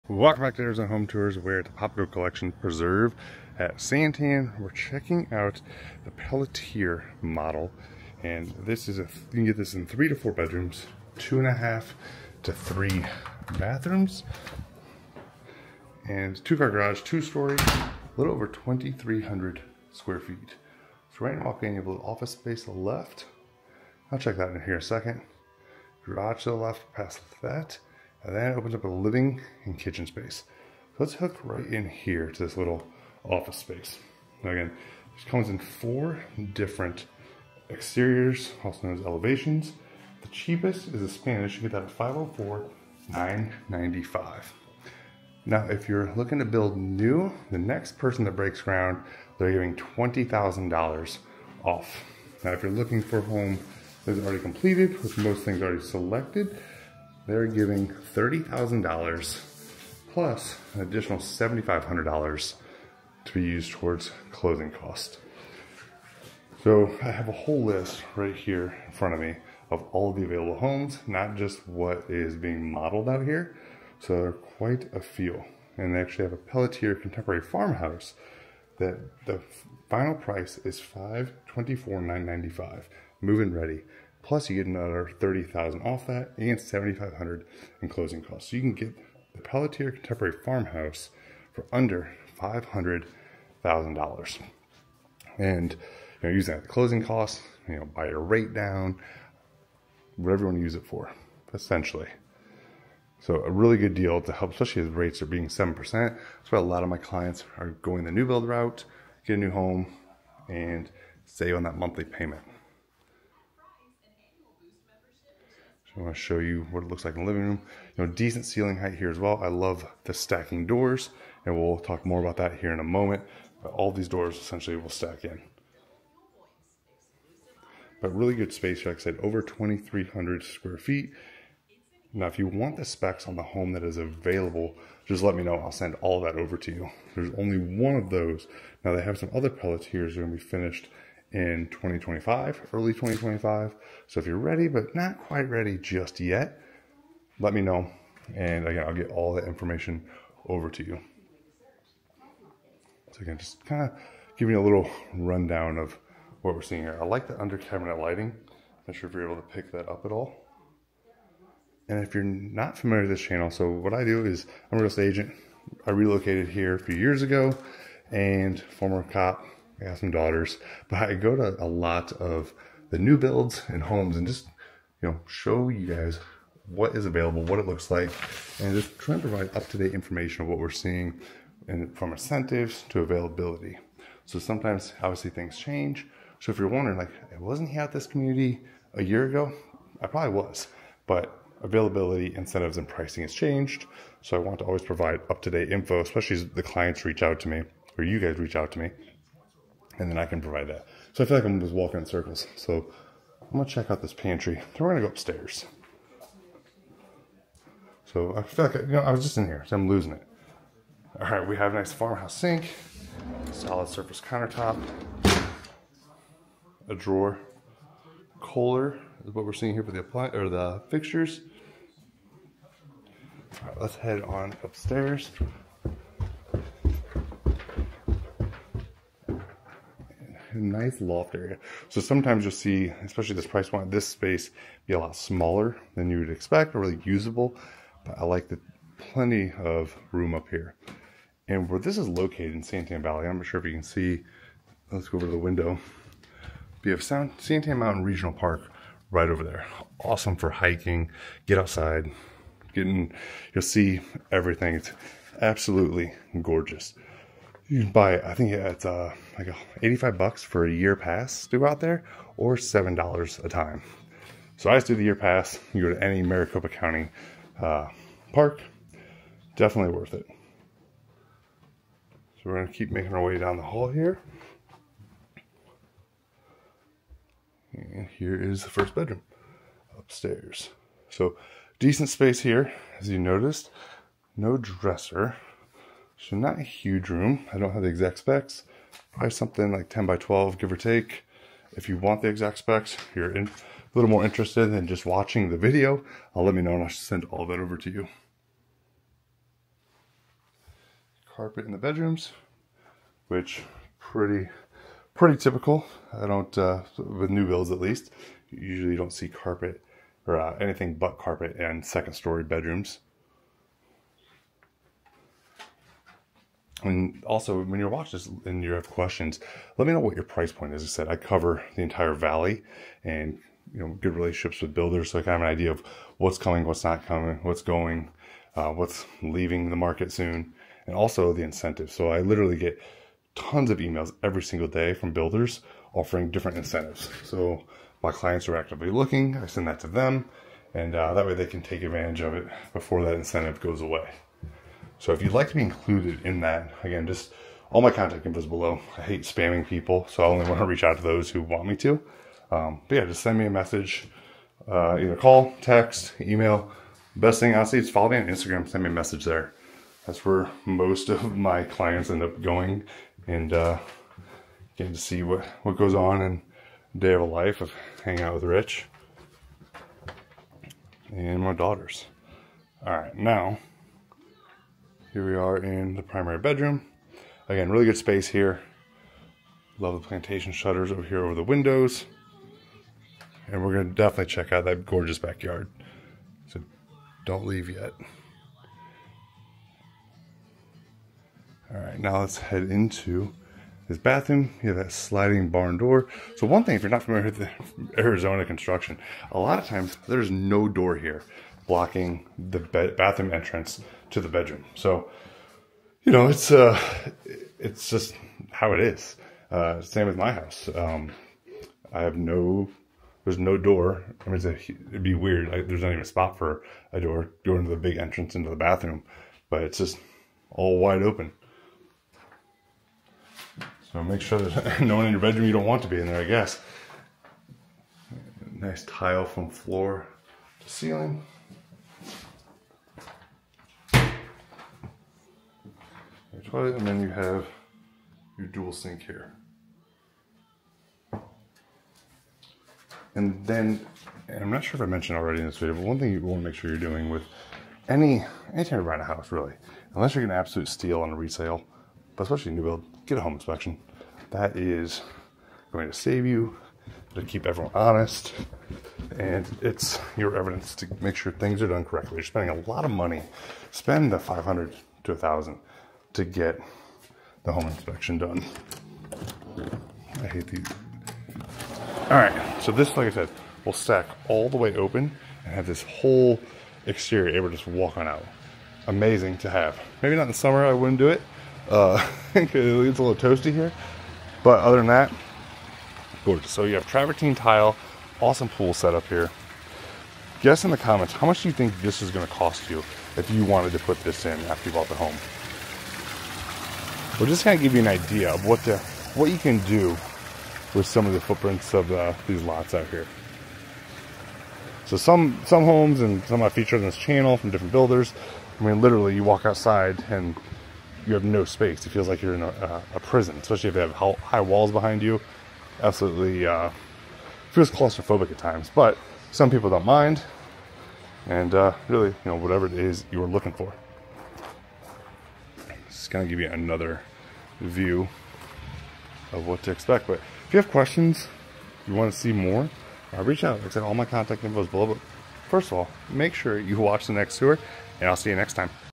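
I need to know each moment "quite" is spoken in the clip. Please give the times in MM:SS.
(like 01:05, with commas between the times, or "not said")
01:14, 02:25.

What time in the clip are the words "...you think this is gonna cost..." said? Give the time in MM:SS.
08:11.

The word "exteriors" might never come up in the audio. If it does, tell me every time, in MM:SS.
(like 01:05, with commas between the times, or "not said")
00:37, 07:56.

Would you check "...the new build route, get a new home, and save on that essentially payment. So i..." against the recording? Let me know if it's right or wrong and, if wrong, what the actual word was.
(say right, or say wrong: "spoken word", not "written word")
wrong: "monthly", not "essentially".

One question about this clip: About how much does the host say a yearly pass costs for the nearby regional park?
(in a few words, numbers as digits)
$85.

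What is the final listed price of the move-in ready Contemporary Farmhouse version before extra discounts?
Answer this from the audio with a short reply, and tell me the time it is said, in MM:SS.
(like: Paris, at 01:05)
524,995, at 01:20.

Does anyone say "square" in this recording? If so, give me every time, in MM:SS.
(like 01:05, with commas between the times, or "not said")
00:19, 02:10.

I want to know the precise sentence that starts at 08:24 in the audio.
So some some homes and some I featured on this channel from different builders.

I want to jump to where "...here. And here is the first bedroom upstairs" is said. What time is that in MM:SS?
04:33.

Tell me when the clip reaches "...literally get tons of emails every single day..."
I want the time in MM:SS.
05:32.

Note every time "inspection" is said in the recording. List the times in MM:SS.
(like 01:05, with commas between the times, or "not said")
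07:33, 07:47.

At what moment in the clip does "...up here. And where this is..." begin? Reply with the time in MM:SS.
04:00.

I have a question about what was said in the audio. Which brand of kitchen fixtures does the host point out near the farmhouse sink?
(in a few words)
Kohler.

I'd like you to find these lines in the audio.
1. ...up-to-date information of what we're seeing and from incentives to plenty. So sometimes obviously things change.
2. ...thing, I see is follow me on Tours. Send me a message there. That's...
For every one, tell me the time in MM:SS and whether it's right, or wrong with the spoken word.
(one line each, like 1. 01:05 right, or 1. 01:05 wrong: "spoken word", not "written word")
1. 02:59 wrong: "availability", not "plenty"
2. 05:57 wrong: "Instagram", not "Tours".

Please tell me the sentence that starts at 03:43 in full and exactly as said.
All right, let's head on upstairs.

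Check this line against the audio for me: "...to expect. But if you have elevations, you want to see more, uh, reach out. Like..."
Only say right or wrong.
wrong.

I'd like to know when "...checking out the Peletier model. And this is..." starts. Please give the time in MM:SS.
00:04.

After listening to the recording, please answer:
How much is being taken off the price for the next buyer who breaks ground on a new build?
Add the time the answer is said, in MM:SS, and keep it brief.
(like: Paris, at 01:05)
$20,000, at 00:49.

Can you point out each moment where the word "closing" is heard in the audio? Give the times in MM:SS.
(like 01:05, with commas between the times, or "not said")
01:04, 01:27, 01:36.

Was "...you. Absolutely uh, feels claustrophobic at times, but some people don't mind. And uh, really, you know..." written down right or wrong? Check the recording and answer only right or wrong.
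right.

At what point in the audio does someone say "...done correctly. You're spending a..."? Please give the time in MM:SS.
07:41.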